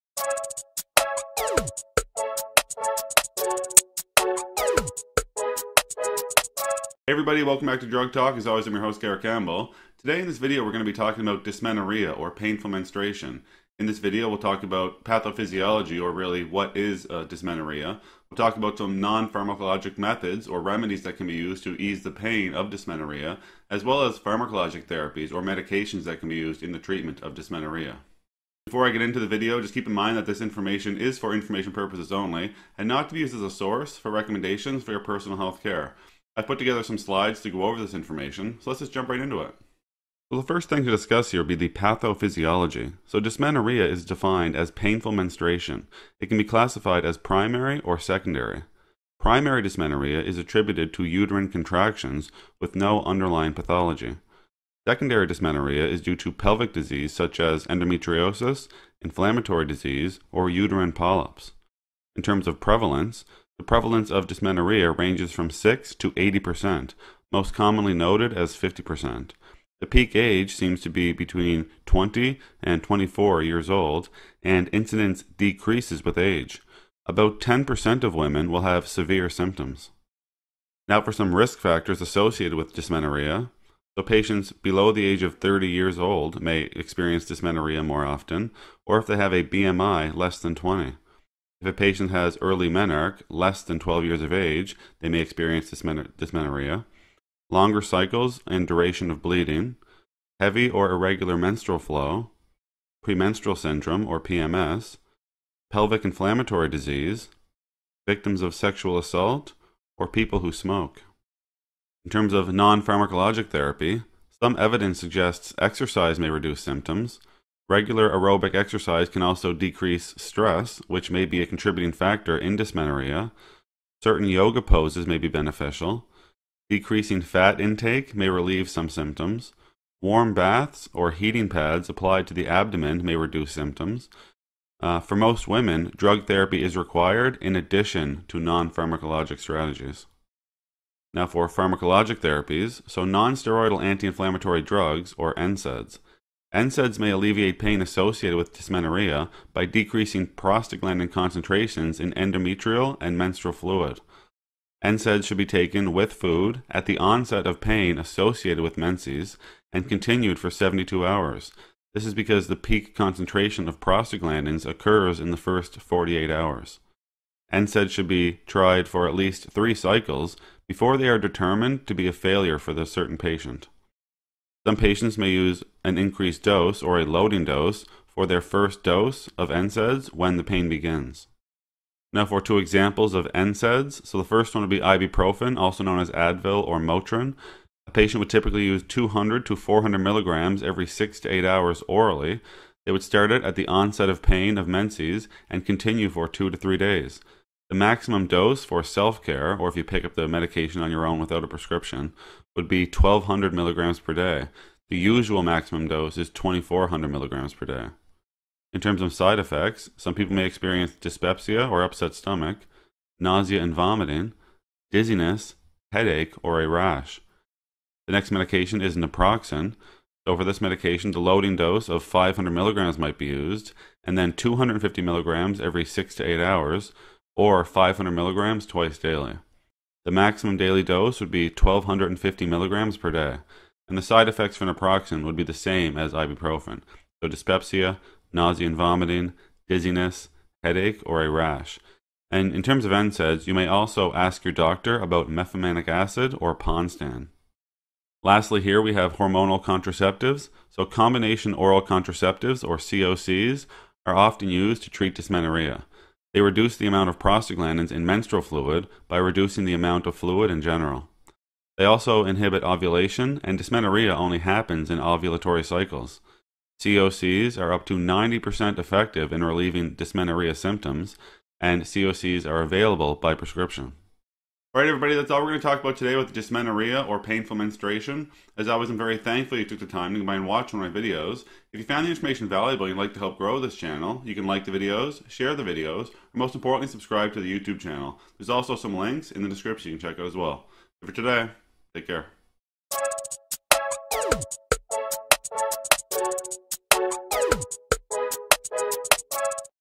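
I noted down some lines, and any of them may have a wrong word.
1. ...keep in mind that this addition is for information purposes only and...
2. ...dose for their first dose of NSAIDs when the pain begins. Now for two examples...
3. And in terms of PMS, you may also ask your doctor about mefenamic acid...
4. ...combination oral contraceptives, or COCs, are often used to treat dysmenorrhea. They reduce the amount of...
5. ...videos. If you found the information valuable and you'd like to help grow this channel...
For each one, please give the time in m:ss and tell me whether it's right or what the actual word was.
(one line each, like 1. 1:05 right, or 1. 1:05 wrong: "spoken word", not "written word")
1. 0:29 wrong: "information", not "addition"
2. 2:57 right
3. 4:02 wrong: "NSAIDs", not "PMS"
4. 4:10 right
5. 4:41 right.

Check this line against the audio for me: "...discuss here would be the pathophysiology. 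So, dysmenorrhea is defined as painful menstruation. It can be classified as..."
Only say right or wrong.
right.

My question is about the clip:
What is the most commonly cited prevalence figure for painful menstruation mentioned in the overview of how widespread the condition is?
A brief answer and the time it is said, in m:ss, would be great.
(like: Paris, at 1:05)
50%, at 1:08.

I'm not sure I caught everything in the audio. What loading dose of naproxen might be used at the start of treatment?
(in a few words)
500 milligrams.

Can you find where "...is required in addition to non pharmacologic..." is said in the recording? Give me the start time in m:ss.
2:16.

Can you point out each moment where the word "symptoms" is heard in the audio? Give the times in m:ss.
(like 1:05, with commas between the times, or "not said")
1:19, 1:56, 2:08, 2:13, 4:30.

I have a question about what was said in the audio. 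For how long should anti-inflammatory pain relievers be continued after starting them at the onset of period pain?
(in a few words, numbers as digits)
72 hours.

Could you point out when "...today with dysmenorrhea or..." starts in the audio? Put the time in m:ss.
4:35.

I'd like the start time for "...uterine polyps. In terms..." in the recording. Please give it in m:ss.
1:00.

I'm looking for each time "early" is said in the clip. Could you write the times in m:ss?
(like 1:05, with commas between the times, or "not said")
1:32.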